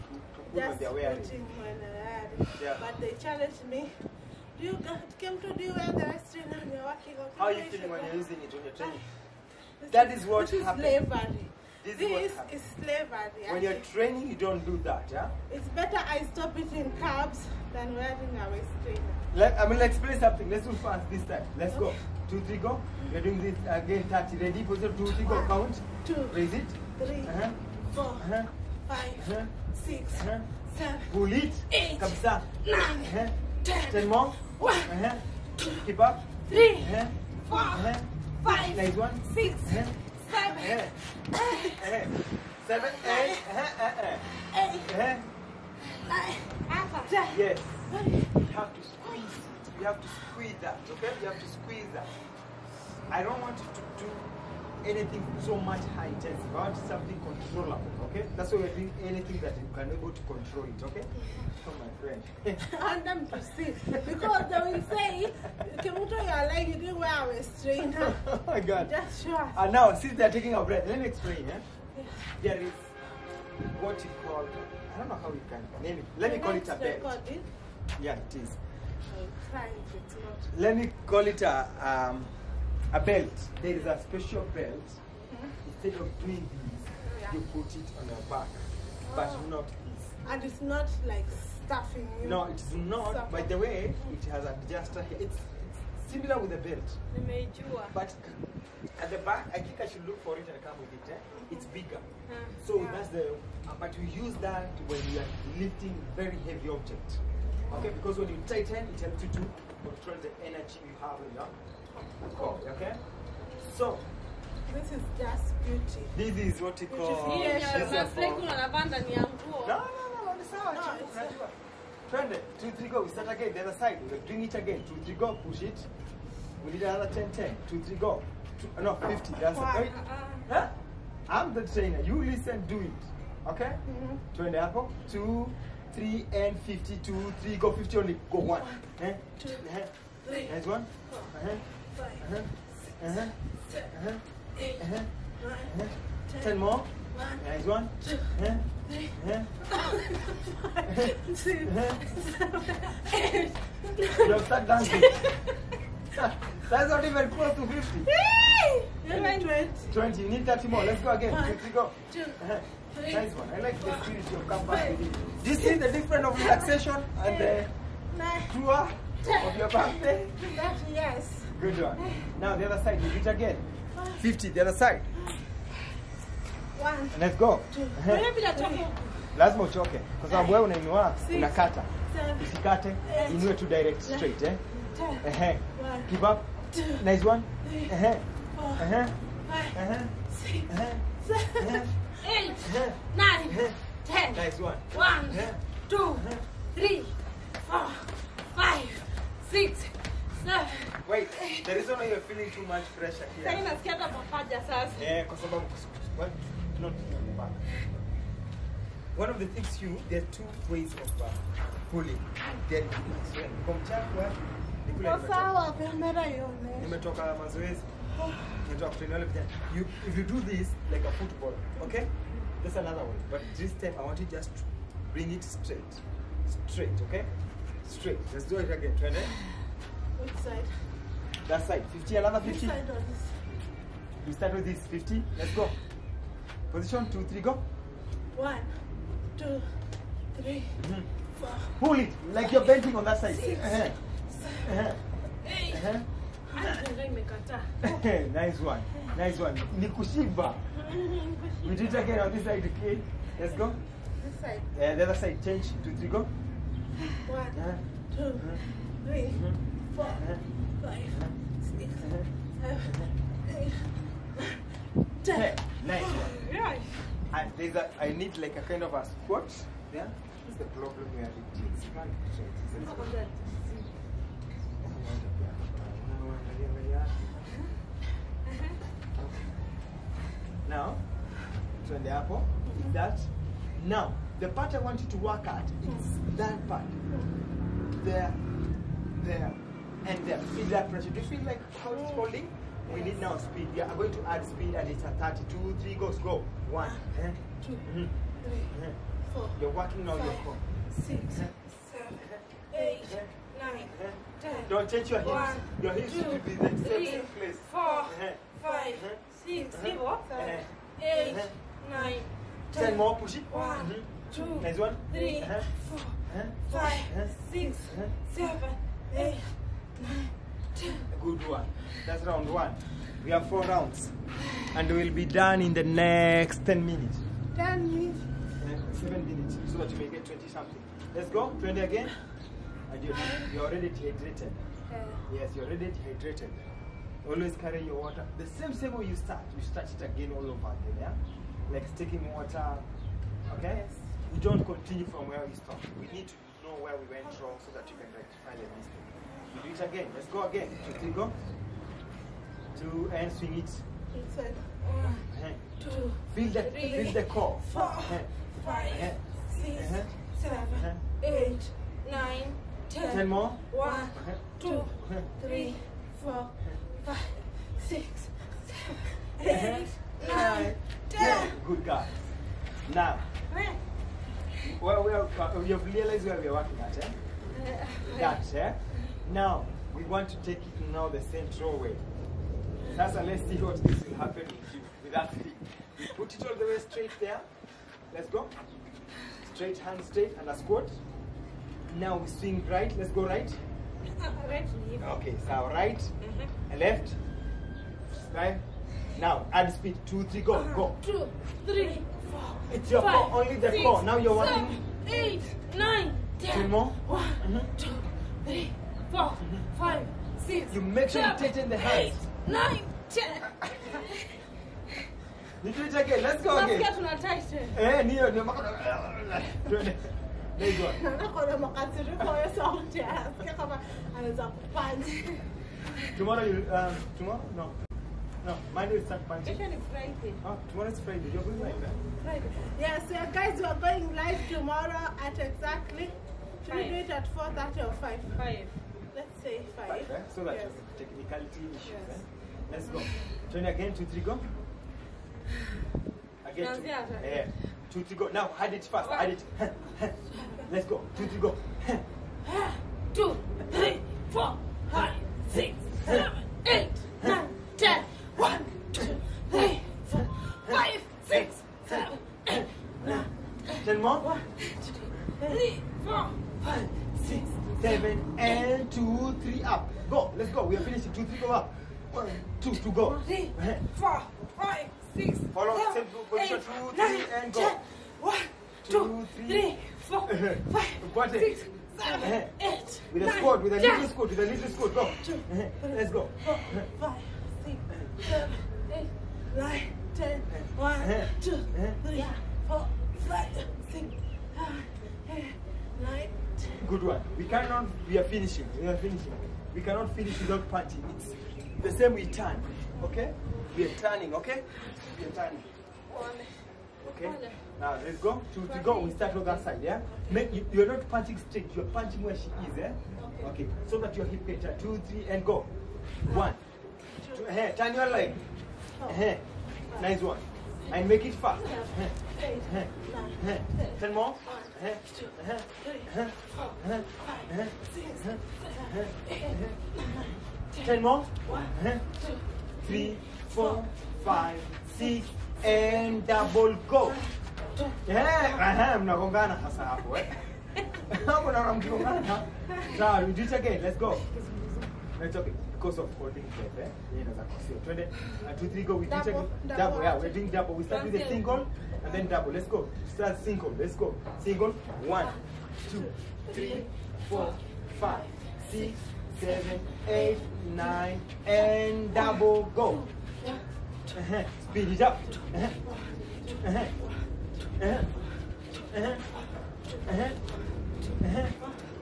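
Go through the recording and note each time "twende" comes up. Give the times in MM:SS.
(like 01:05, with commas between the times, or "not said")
02:02, 02:14, 04:41, 09:07.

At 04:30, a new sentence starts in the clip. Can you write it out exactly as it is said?
This the problem we are reaching.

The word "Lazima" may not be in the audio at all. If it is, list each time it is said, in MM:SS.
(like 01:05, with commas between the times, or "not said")
03:00.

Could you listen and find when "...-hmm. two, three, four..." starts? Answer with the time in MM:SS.
06:47.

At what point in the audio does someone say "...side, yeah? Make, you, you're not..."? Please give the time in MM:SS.
08:29.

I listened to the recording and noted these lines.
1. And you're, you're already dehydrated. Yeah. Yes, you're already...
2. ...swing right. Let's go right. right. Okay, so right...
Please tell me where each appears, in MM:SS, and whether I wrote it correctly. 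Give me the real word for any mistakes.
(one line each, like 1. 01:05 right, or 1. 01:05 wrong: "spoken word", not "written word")
1. 05:32 right
2. 06:32 right.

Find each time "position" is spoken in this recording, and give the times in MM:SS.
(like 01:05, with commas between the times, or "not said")
00:24, 03:56, 07:56.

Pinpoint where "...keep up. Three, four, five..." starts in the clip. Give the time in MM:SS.
00:35.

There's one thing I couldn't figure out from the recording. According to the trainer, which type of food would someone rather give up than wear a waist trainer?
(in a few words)
Carbs.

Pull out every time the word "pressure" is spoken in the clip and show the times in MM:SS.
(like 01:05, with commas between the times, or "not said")
03:22, 04:50.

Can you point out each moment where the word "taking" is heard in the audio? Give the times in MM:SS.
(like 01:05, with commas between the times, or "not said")
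01:10, 05:41.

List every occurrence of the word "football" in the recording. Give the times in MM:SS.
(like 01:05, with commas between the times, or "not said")
03:41.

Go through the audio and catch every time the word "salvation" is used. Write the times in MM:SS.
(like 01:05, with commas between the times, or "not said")
not said.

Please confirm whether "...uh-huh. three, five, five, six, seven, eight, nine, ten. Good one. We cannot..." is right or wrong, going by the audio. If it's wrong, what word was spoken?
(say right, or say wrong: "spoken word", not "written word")
wrong: "four", not "five".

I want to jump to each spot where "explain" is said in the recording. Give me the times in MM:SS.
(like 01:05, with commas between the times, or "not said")
01:11.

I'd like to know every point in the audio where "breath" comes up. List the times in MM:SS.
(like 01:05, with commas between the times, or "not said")
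01:10, 09:06.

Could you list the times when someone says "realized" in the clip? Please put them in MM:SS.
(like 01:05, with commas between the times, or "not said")
06:15.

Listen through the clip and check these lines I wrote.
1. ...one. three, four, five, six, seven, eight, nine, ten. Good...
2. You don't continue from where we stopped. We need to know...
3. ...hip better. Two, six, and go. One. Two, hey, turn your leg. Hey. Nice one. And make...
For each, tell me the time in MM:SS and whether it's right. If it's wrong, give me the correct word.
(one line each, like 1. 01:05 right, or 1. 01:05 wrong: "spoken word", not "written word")
1. 05:14 right
2. 05:44 right
3. 08:34 wrong: "three", not "six".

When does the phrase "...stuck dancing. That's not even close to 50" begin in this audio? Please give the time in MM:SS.
02:34.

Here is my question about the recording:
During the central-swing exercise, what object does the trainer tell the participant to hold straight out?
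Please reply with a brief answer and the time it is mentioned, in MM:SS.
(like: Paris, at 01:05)
Stick, at 06:25.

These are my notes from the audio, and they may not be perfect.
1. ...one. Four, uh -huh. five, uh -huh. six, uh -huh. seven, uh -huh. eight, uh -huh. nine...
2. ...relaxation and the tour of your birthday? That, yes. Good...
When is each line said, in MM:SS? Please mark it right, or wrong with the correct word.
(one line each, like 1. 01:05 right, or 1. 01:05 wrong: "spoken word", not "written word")
1. 02:20 right
2. 02:46 right.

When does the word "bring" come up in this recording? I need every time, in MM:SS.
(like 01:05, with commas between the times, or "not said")
02:04, 03:45.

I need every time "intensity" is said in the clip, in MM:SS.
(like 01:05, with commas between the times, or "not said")
00:56.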